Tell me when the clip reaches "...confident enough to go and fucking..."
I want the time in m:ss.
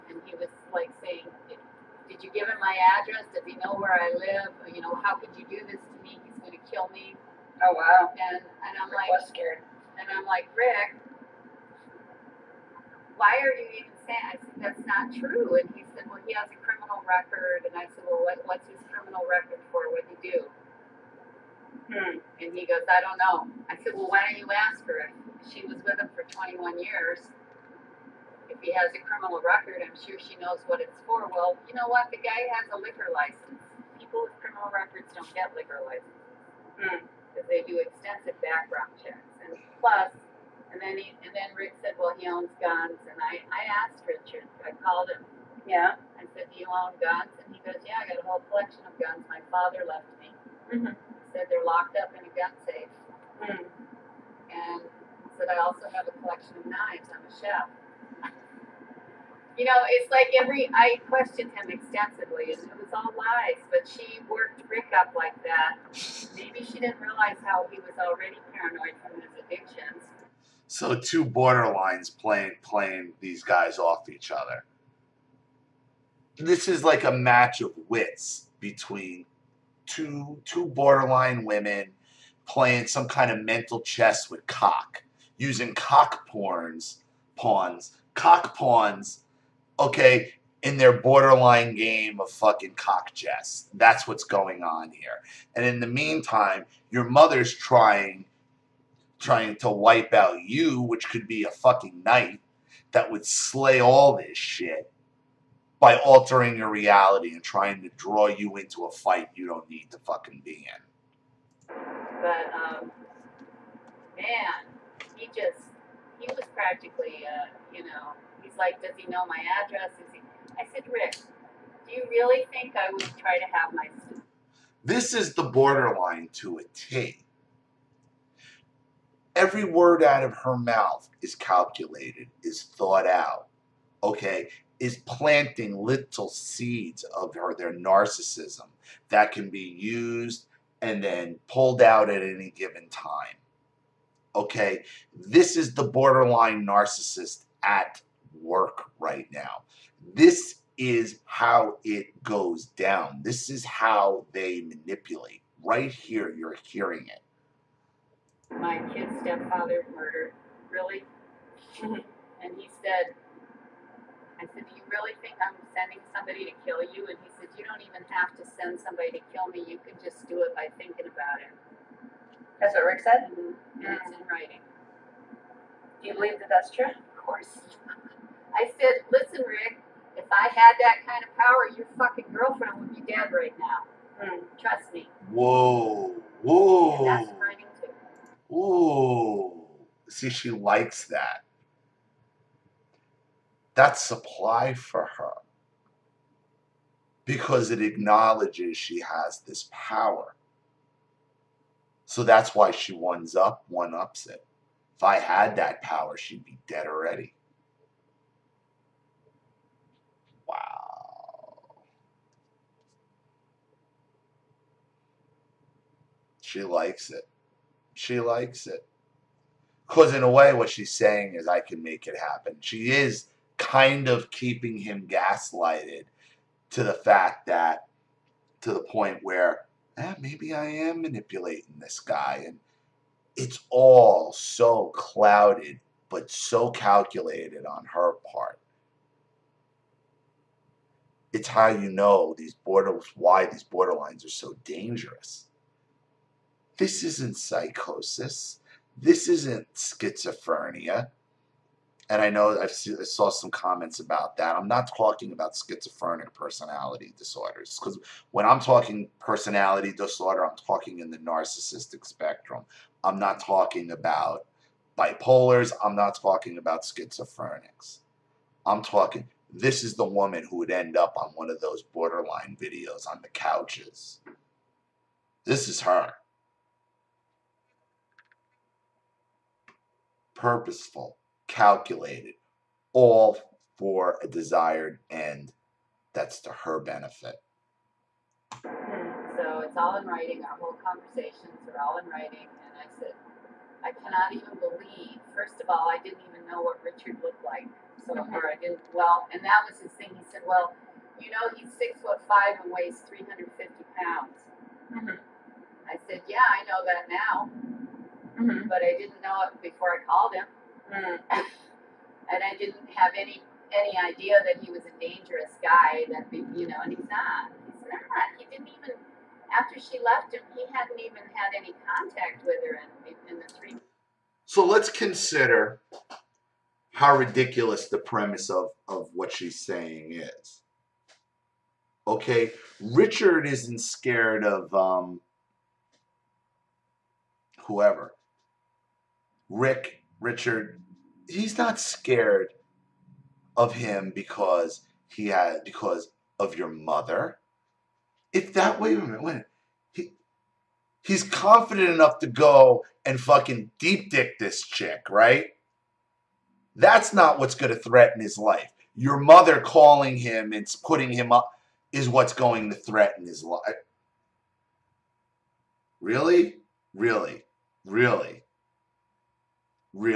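5:51.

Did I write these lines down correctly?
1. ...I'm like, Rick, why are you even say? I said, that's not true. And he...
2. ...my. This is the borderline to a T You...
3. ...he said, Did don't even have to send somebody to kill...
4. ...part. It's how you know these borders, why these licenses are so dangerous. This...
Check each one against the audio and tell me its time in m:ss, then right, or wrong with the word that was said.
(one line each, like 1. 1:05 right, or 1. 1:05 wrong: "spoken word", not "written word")
1. 0:10 right
2. 2:03 wrong: "Every", not "You"
3. 2:47 wrong: "You", not "Did"
4. 3:58 wrong: "borderlines", not "licenses".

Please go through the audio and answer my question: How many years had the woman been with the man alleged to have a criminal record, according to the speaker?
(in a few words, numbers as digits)
21 years.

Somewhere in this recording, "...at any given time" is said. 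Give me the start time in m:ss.
2:22.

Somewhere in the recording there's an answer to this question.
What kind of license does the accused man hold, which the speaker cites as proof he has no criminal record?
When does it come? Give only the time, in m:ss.
0:32.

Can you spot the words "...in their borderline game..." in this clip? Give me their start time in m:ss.
1:30.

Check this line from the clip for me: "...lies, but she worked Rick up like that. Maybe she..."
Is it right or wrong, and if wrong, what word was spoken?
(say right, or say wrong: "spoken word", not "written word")
right.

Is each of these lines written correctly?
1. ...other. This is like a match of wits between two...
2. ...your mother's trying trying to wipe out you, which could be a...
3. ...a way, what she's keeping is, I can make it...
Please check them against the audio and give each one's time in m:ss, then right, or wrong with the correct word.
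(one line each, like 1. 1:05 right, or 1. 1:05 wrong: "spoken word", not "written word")
1. 1:14 right
2. 1:36 right
3. 3:40 wrong: "saying", not "keeping".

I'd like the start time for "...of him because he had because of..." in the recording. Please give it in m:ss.
5:43.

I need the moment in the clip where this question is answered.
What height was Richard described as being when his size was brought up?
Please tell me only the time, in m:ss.
5:01.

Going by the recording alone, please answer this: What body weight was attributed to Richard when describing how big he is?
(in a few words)
350 pounds.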